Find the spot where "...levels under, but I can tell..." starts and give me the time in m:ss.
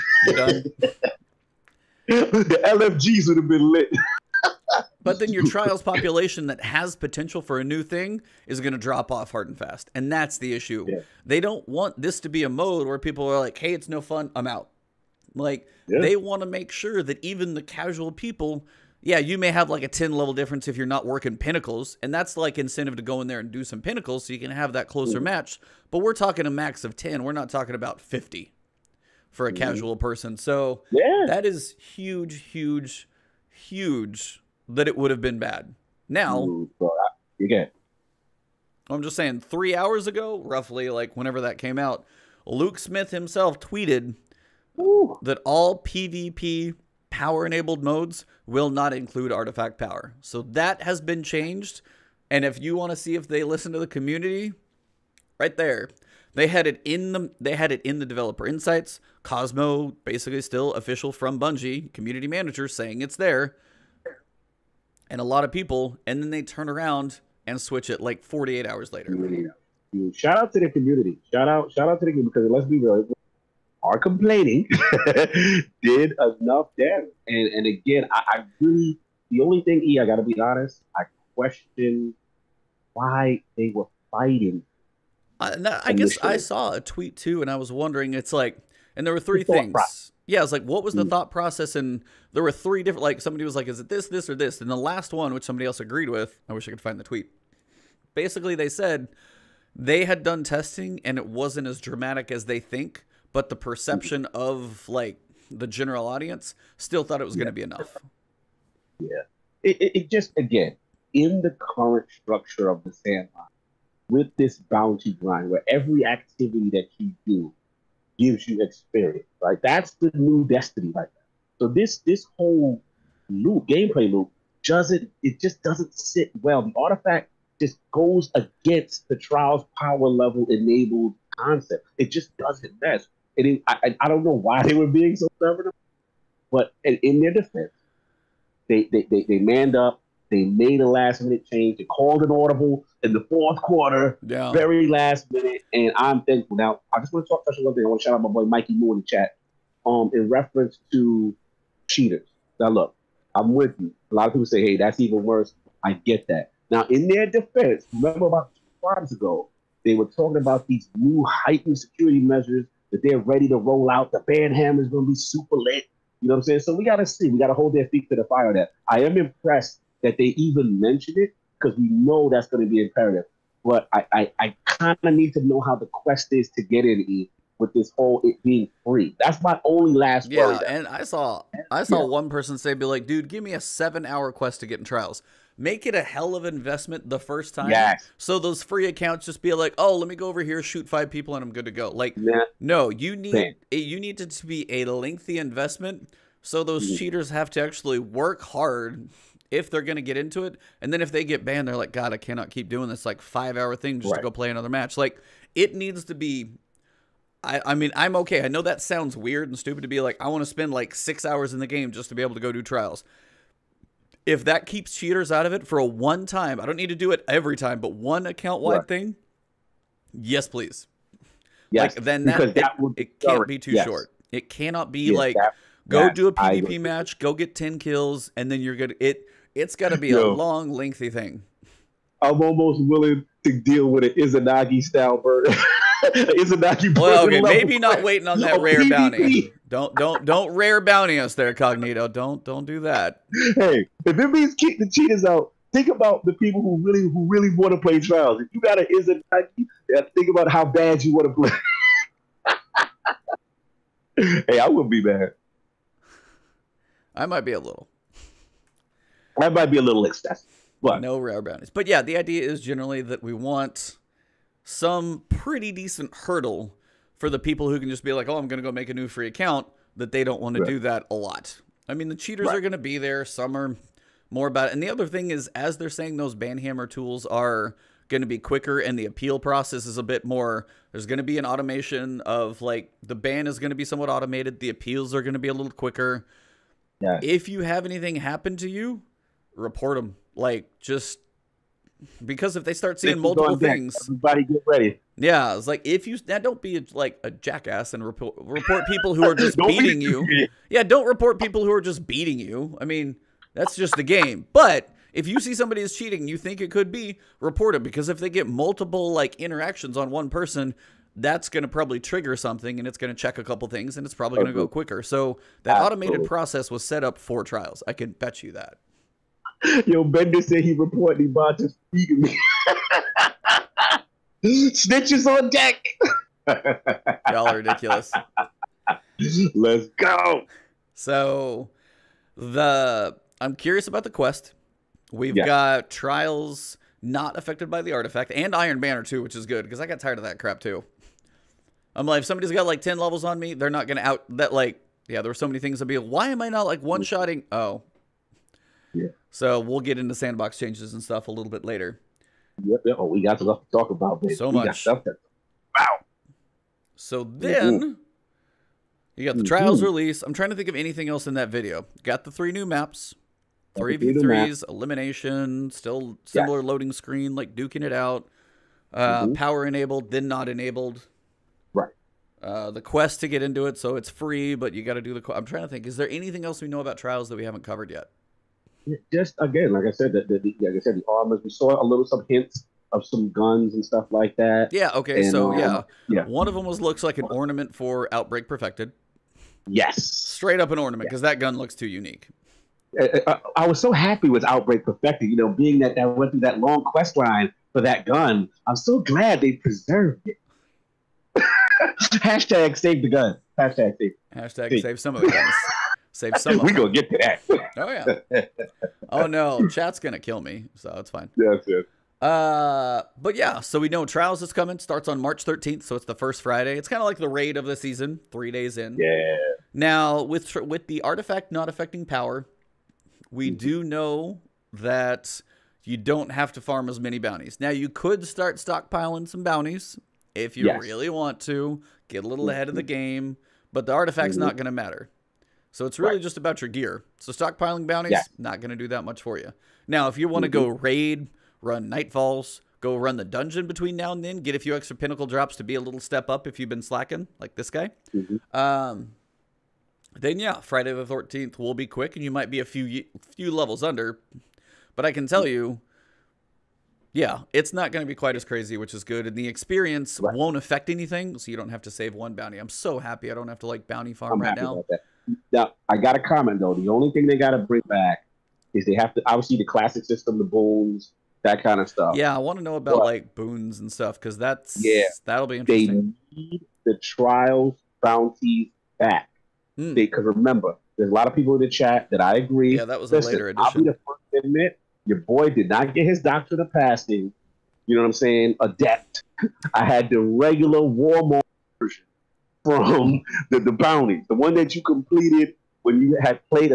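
7:33.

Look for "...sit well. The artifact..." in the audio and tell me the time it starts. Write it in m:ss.
2:05.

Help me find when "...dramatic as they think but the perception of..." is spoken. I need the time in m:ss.
1:41.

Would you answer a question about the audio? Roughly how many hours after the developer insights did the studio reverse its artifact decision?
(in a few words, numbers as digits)
48.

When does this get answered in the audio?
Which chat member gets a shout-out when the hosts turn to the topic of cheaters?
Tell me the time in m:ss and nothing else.
2:28.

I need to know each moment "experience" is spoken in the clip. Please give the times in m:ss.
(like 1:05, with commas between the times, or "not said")
1:58, 7:39.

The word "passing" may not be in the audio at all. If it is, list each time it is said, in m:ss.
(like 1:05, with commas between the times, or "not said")
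8:06.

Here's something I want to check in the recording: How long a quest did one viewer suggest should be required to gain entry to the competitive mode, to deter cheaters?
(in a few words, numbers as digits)
7 hours.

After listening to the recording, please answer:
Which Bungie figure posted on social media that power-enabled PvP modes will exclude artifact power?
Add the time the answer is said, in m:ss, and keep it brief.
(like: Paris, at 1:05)
Luke Smith, at 0:42.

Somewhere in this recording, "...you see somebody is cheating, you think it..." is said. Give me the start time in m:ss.
5:05.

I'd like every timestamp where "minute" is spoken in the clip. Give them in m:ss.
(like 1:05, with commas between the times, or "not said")
2:21, 2:25.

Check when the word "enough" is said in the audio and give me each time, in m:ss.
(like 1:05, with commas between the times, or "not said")
1:16, 1:47.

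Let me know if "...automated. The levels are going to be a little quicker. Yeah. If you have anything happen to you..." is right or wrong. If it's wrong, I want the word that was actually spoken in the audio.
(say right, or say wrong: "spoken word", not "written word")
wrong: "appeals", not "levels".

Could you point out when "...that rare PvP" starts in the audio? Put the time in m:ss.
3:58.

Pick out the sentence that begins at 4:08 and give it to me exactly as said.
If you got an is it Yeah, think about how bad you want to play.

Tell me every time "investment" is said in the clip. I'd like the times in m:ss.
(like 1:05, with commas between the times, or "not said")
3:06, 3:15.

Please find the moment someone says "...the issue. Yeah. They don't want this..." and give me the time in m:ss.
0:10.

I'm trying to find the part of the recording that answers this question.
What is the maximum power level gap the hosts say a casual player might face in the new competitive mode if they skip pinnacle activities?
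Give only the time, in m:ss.
0:26.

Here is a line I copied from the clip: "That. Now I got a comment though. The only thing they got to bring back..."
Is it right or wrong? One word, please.
right.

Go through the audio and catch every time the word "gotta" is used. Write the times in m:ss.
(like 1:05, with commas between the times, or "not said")
1:20.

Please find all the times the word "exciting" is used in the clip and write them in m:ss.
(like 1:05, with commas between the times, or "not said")
not said.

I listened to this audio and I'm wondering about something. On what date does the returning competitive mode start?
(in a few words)
March 13.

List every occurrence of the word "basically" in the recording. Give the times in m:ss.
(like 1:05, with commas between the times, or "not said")
1:00, 1:38.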